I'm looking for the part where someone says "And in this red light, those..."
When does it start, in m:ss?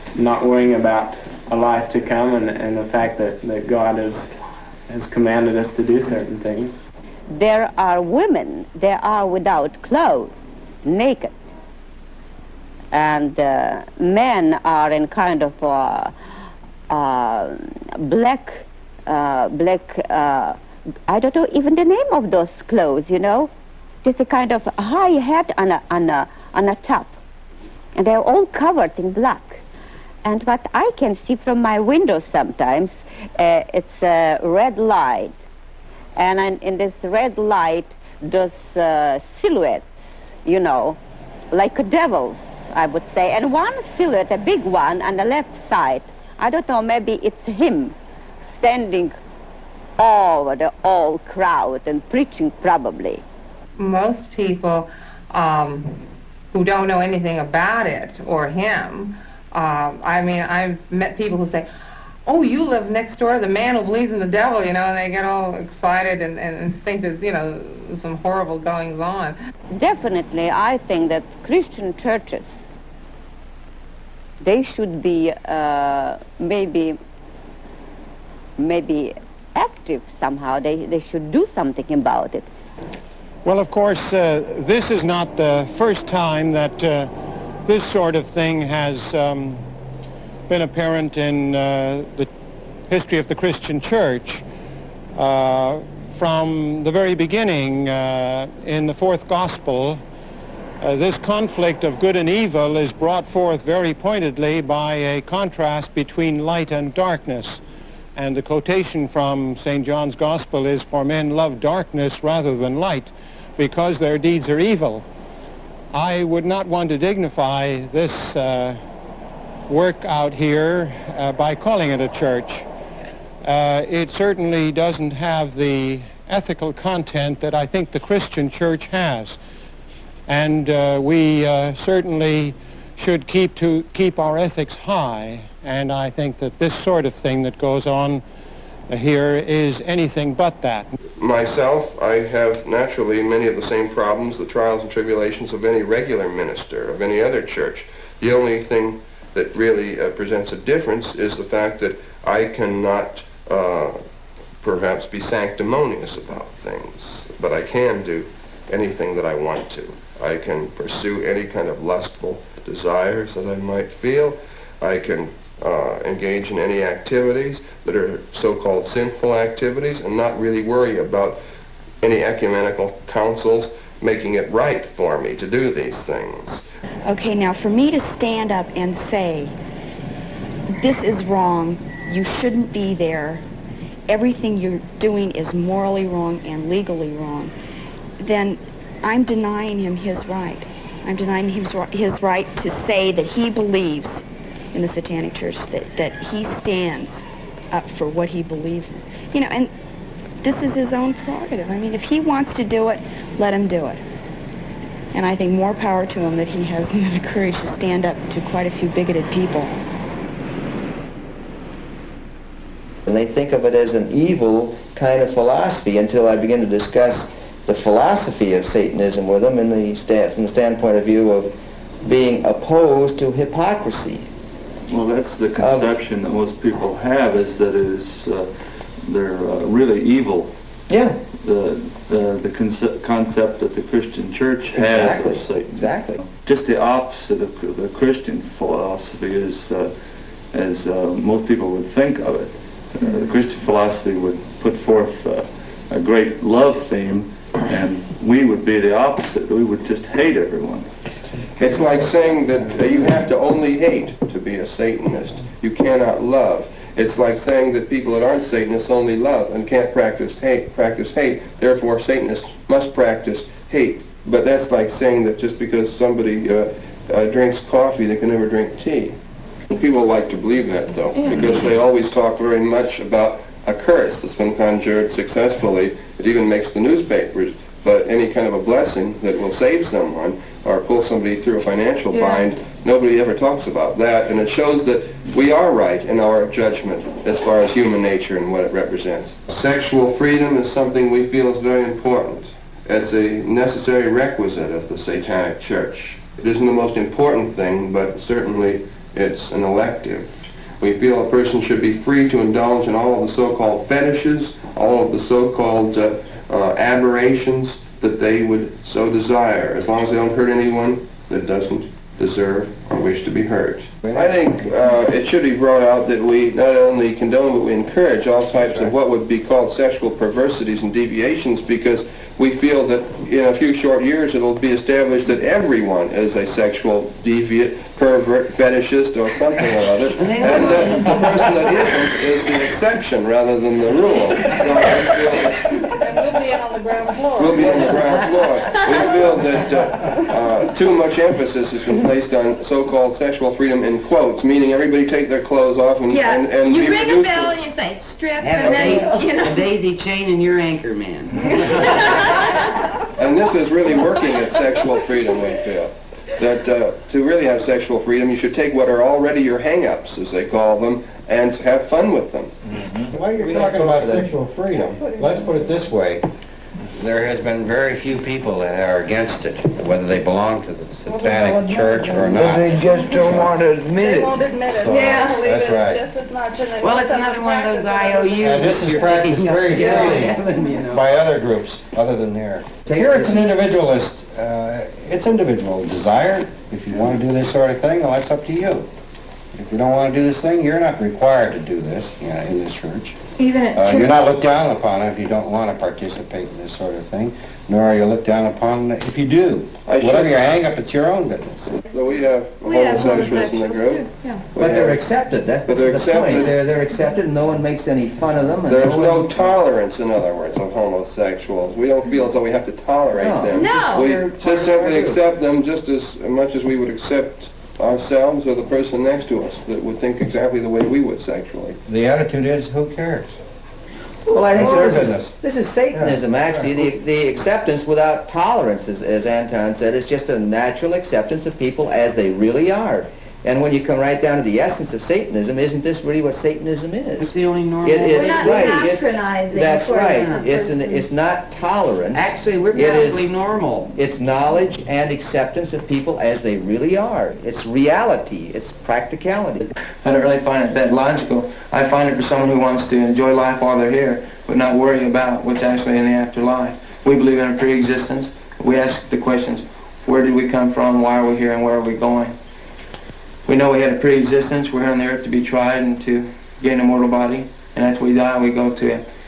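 0:36.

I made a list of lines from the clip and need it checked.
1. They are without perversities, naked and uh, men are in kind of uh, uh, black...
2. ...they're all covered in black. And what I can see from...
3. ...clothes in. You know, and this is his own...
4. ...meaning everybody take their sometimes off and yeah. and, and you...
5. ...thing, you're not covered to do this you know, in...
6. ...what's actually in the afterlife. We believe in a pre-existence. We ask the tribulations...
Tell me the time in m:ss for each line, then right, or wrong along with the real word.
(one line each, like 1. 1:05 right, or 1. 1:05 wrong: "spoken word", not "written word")
1. 0:08 wrong: "clothes", not "perversities"
2. 0:28 right
3. 3:18 wrong: "believes", not "clothes"
4. 5:44 wrong: "clothes", not "sometimes"
5. 6:30 wrong: "required", not "covered"
6. 7:35 wrong: "questions", not "tribulations".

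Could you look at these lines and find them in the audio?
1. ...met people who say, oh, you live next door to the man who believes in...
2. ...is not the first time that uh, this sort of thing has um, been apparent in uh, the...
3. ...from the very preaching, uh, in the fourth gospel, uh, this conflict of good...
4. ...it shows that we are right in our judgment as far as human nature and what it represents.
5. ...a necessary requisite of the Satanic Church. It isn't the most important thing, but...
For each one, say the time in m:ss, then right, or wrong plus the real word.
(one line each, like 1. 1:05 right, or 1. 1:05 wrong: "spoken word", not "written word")
1. 1:00 right
2. 1:24 right
3. 1:36 wrong: "beginning", not "preaching"
4. 4:44 right
5. 4:53 right.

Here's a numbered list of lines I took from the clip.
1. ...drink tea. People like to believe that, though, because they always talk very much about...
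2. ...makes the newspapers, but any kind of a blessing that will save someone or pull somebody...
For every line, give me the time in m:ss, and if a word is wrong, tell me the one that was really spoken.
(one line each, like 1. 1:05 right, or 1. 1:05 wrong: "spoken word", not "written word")
1. 4:28 right
2. 4:36 right.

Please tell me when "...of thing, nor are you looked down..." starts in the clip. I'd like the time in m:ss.
6:36.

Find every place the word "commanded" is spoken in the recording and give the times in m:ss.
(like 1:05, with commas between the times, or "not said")
0:05.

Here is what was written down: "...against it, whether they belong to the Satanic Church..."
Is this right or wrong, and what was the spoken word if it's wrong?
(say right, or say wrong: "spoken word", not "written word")
right.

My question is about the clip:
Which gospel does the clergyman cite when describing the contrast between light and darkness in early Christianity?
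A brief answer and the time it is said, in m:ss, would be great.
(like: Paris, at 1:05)
St. John's Gospel, at 1:49.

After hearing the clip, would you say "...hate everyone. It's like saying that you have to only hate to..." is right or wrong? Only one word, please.
right.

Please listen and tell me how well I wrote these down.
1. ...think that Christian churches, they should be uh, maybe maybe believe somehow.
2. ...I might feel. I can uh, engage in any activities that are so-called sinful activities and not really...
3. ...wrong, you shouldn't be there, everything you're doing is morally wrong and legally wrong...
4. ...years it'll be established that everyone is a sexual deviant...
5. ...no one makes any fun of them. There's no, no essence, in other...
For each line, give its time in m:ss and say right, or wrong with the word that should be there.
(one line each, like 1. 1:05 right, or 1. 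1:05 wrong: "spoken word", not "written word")
1. 1:10 wrong: "active", not "believe"
2. 2:43 right
3. 3:01 right
4. 5:24 right
5. 6:47 wrong: "tolerance", not "essence".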